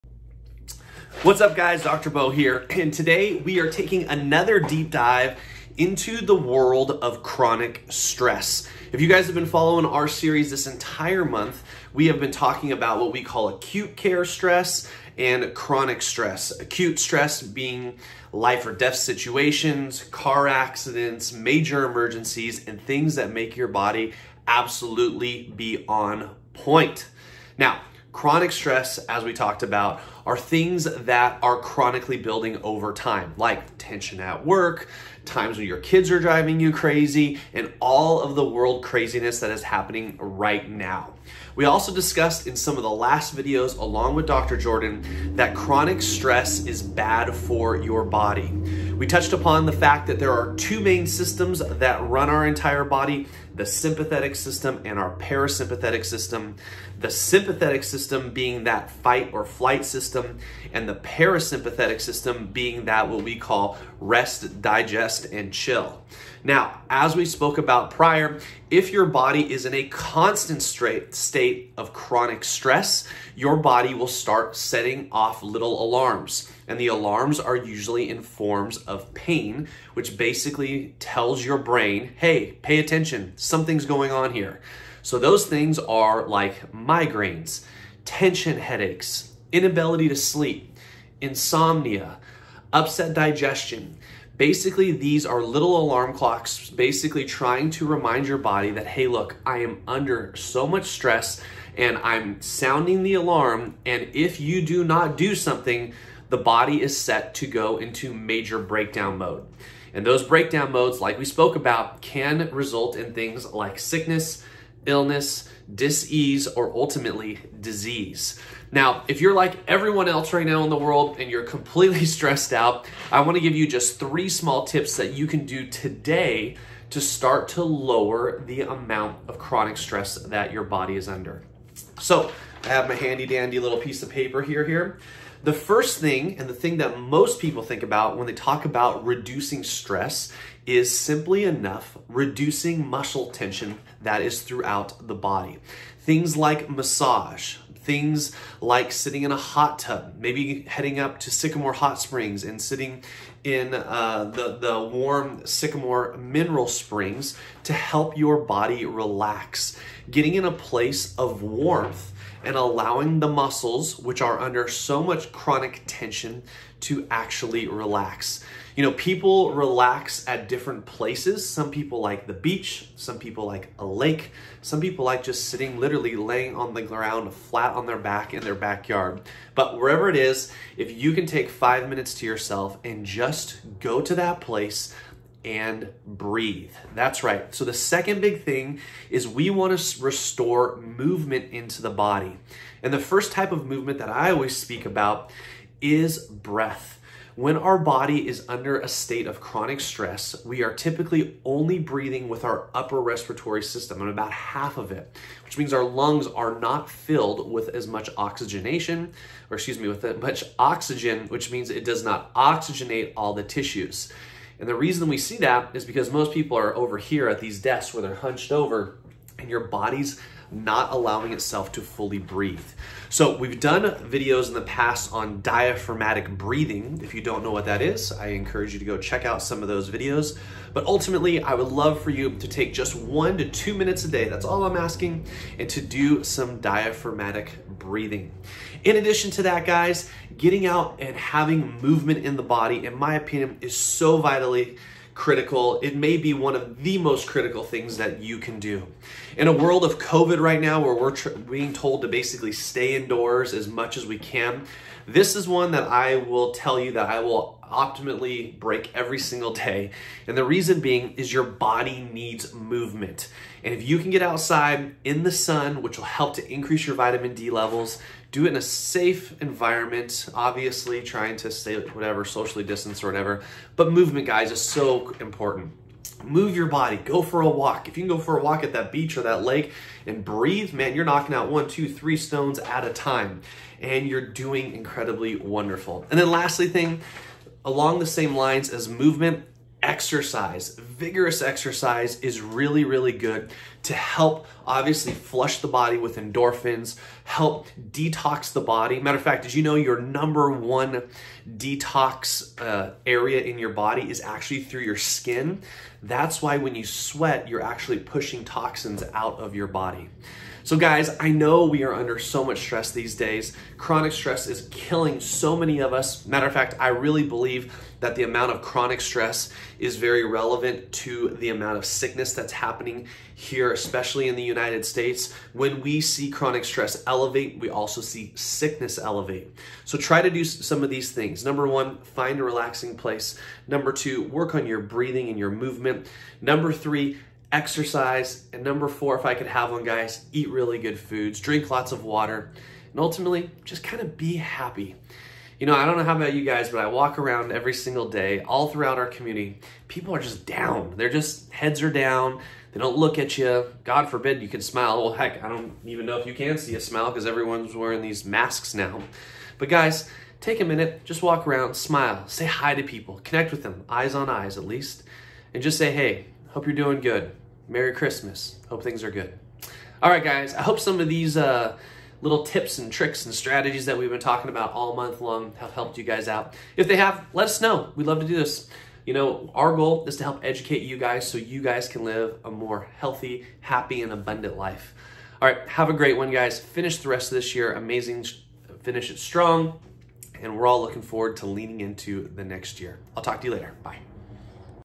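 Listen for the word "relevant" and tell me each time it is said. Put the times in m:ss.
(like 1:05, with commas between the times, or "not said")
5:20.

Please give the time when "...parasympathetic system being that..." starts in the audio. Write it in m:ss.
1:00.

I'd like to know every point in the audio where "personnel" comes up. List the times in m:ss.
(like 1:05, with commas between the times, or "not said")
not said.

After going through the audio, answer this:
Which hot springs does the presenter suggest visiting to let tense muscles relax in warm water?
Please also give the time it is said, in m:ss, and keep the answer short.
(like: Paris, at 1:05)
Sycamore Hot Springs, at 2:31.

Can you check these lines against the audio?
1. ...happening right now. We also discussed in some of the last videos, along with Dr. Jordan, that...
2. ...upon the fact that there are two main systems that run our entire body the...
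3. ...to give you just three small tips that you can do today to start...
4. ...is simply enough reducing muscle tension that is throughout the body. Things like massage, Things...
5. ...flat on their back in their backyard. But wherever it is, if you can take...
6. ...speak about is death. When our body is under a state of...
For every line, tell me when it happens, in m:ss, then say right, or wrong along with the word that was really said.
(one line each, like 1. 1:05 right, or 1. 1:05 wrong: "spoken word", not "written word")
1. 0:39 right
2. 0:49 right
3. 2:03 right
4. 2:20 right
5. 2:57 right
6. 3:14 wrong: "breath", not "death".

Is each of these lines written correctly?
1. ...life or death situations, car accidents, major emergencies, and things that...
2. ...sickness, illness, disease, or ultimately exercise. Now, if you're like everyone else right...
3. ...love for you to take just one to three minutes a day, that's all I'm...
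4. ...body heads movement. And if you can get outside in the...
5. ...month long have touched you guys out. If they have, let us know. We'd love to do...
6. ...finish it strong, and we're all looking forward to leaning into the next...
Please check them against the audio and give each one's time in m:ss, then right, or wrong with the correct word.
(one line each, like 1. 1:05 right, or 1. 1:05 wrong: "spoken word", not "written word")
1. 0:18 right
2. 1:53 wrong: "disease", not "exercise"
3. 3:51 wrong: "two", not "three"
4. 4:21 wrong: "needs", not "heads"
5. 6:14 wrong: "helped", not "touched"
6. 6:28 right.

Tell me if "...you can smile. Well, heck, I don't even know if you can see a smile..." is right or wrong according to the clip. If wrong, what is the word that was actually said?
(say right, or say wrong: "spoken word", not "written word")
right.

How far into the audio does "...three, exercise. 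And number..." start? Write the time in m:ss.
5:36.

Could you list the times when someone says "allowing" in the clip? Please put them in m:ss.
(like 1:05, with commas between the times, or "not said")
2:42, 3:40.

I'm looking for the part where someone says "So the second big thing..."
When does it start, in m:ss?
3:07.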